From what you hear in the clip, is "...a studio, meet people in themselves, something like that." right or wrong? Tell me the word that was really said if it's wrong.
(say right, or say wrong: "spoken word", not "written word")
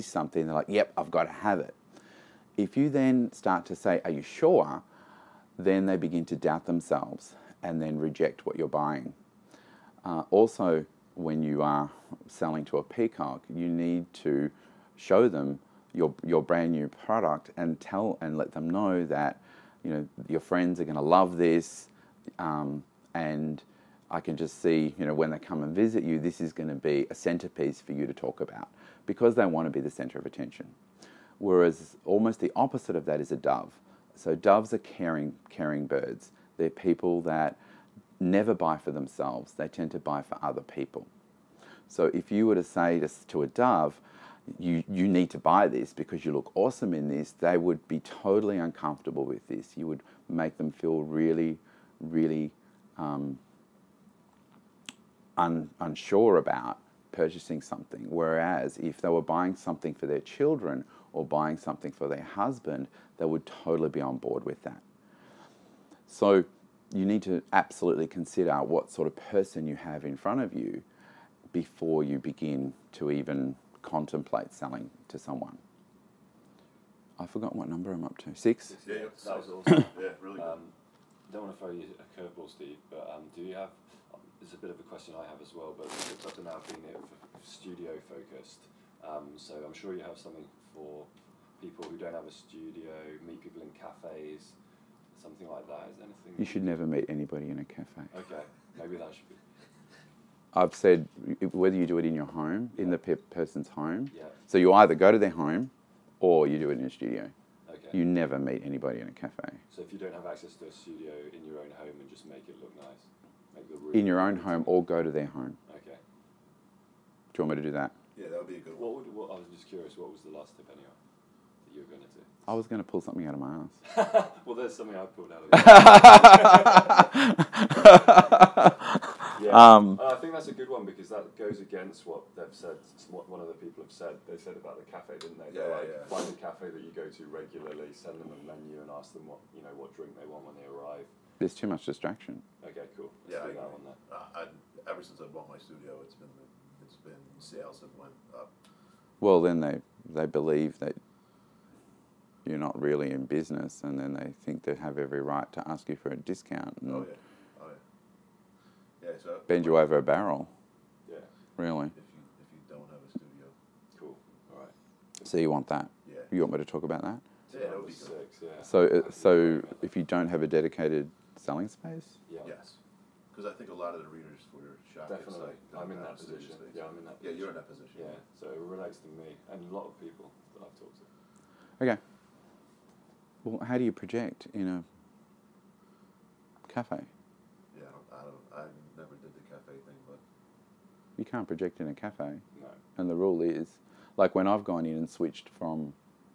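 wrong: "cafes", not "themselves".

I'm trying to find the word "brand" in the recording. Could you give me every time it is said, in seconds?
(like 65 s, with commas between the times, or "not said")
16 s.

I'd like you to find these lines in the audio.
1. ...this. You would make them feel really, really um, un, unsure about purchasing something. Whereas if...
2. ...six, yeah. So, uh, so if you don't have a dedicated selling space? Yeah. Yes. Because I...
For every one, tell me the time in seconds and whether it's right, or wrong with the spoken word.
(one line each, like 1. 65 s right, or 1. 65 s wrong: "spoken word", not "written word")
1. 49 s right
2. 167 s right.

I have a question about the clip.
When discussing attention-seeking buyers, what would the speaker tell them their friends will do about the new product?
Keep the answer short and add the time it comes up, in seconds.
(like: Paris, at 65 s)
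love this, at 21 s.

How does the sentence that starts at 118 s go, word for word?
What would, what, I was just curious, what was the last tip anyway that you were going to do?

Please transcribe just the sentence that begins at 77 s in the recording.
I forgot what number I'm up to.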